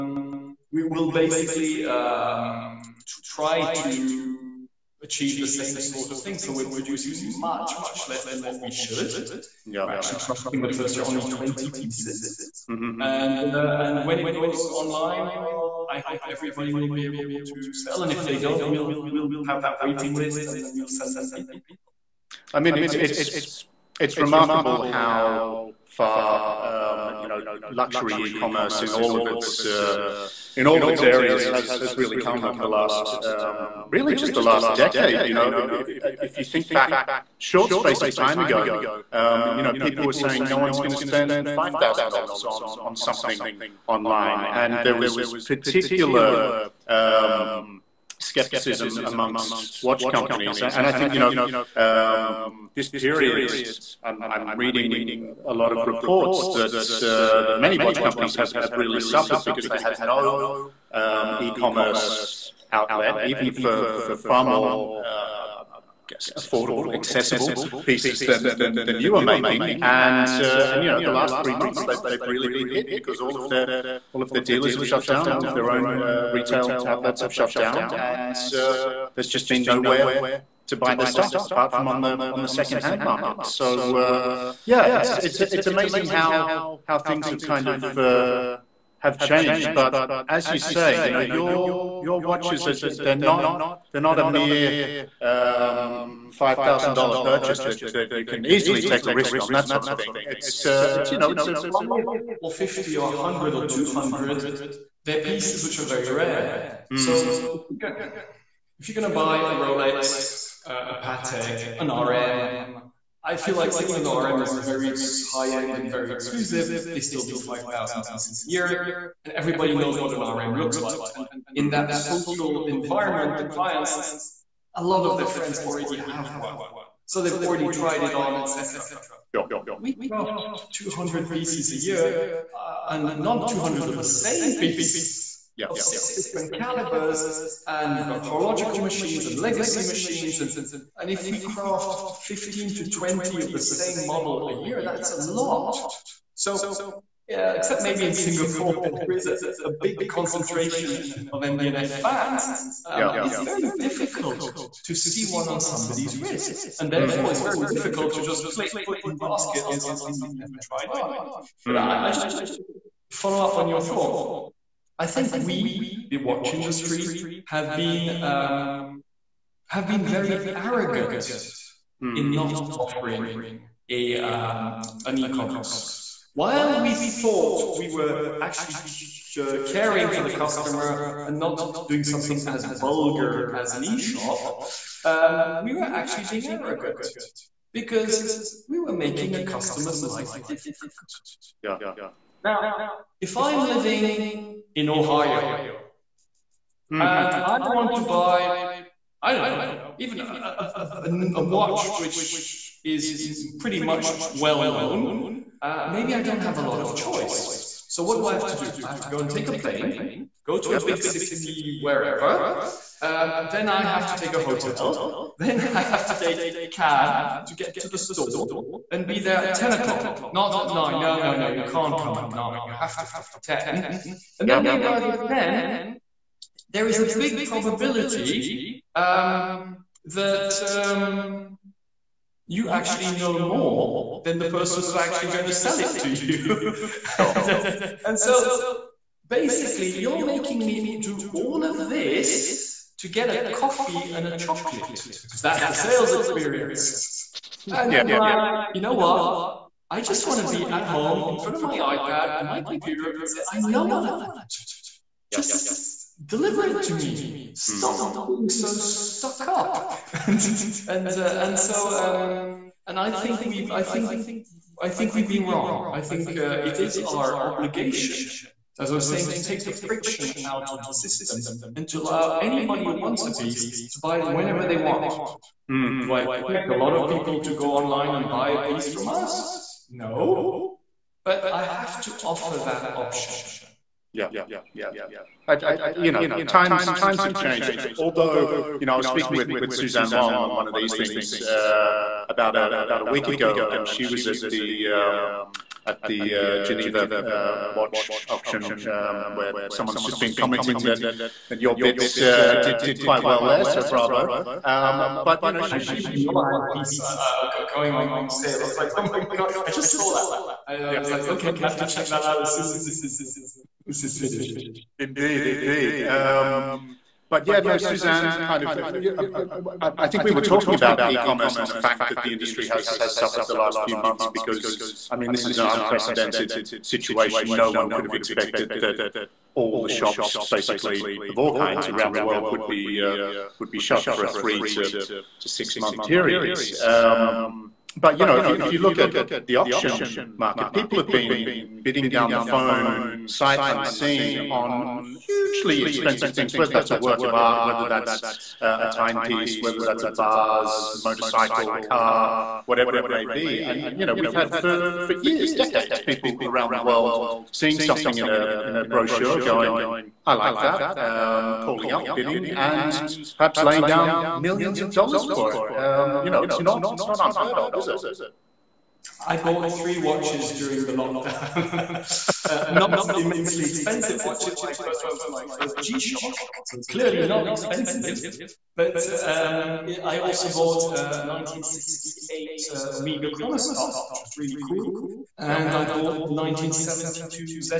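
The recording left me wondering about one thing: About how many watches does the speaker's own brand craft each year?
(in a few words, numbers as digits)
200.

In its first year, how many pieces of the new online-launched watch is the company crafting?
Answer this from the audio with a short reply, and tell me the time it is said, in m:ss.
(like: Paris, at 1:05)
20, at 0:11.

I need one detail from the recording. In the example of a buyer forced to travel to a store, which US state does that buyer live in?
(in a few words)
Ohio.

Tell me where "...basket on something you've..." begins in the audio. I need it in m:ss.
2:39.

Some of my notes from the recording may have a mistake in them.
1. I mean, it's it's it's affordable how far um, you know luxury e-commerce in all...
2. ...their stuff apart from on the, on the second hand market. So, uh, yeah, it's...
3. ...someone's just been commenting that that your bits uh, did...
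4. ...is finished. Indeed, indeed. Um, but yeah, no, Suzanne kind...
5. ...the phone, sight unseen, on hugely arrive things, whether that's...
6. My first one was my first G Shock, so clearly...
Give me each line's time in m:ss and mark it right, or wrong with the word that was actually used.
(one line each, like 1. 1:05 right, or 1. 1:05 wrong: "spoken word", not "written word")
1. 0:22 wrong: "remarkable", not "affordable"
2. 1:20 right
3. 4:59 right
4. 5:14 right
5. 5:42 wrong: "expensive", not "arrive"
6. 6:14 right.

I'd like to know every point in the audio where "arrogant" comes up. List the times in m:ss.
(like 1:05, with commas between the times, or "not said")
2:50, 3:06.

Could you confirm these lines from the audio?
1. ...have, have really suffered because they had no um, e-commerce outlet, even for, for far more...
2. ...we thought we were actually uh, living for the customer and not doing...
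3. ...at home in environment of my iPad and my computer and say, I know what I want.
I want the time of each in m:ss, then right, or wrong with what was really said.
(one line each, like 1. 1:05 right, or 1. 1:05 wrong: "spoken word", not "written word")
1. 0:58 right
2. 2:56 wrong: "caring", not "living"
3. 4:10 wrong: "front", not "environment".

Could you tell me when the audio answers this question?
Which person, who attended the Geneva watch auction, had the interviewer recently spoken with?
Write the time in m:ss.
4:49.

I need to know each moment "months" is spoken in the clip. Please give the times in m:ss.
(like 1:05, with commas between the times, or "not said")
1:11, 5:23, 5:35.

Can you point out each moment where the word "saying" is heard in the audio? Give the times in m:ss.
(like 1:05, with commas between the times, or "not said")
0:40, 1:53, 4:29.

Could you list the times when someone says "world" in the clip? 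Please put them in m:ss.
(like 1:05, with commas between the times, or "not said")
5:32, 5:56.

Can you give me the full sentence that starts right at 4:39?
No, but I have to offer that option.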